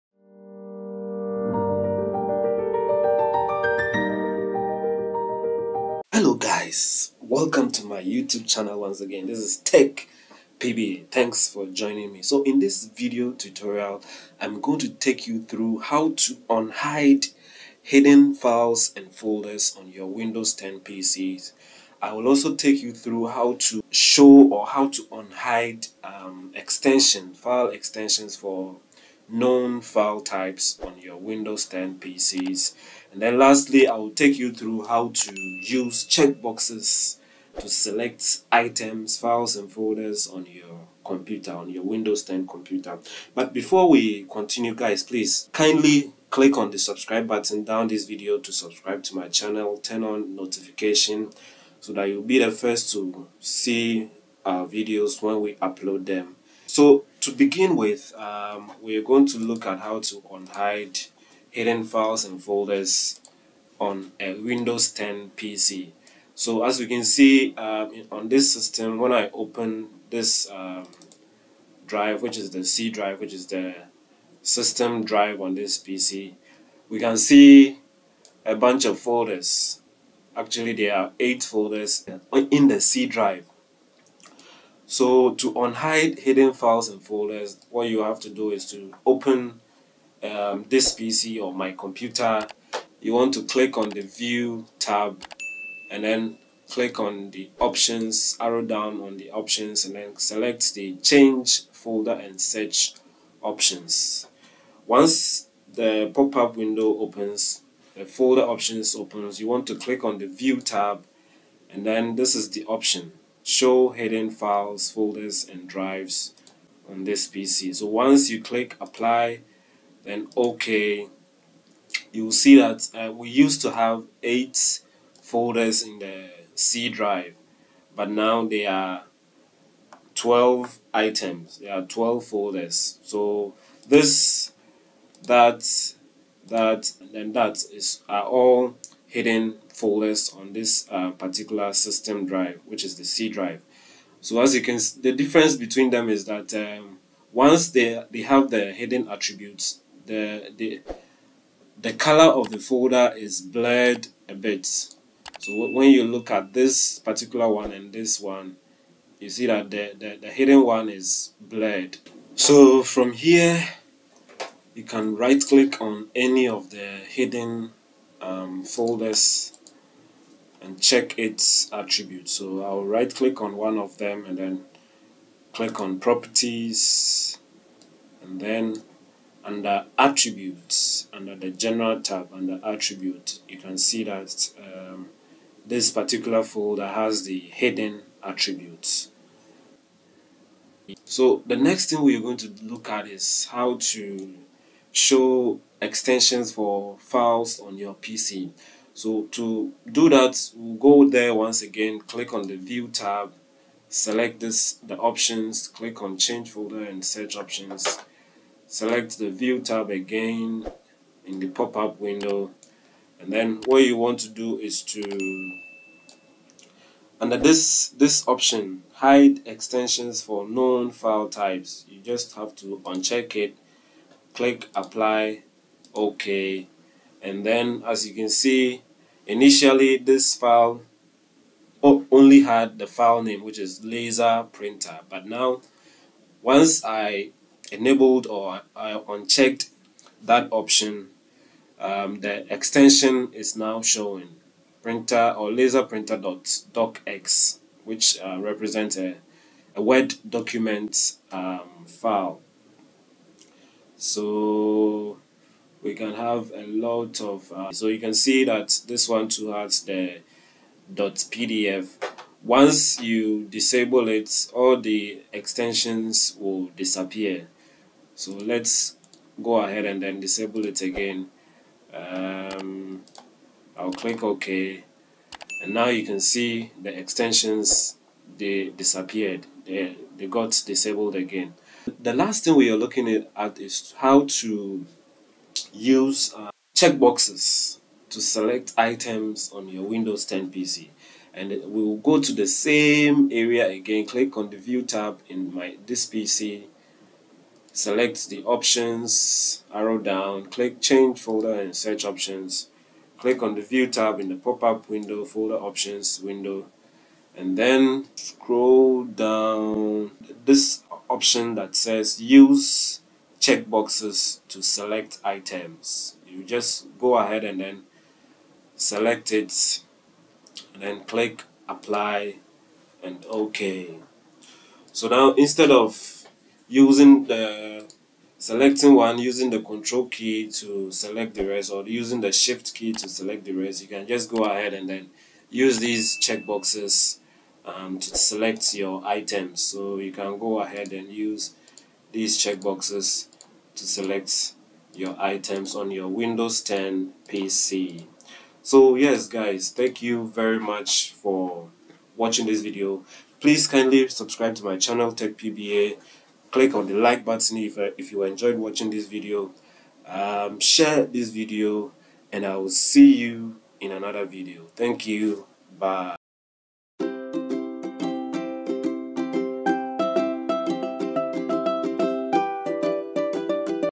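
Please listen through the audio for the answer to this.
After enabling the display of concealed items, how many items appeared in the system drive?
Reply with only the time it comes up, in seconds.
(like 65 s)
130 s.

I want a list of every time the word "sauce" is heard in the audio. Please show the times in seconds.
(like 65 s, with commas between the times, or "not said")
not said.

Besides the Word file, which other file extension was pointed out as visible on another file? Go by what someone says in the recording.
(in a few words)
.pdf.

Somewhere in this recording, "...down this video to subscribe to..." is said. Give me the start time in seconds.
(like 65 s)
47 s.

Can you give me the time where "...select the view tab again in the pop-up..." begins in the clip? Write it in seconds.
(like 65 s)
208 s.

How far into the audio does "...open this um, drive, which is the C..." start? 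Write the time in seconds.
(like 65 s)
69 s.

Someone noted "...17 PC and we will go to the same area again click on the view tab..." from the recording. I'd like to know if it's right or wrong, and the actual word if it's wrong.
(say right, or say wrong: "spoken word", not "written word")
wrong: "10", not "17".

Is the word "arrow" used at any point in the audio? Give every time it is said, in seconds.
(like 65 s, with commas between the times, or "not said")
98 s, 299 s.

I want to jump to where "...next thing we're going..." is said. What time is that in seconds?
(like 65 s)
191 s.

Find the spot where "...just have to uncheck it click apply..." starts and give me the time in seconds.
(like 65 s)
221 s.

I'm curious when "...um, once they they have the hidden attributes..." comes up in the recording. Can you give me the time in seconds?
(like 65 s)
146 s.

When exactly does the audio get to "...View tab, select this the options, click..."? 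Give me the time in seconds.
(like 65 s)
202 s.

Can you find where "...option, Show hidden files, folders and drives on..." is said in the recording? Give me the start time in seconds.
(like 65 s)
112 s.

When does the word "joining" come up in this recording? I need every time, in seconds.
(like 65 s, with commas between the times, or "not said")
11 s.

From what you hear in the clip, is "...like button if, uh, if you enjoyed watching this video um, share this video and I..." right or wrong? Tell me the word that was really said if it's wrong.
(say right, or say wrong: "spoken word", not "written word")
right.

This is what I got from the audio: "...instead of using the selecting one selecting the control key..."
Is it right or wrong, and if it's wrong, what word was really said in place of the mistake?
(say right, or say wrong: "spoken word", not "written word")
wrong: "using", not "selecting".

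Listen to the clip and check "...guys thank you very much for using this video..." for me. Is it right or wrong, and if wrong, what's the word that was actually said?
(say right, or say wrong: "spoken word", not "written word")
wrong: "watching", not "using".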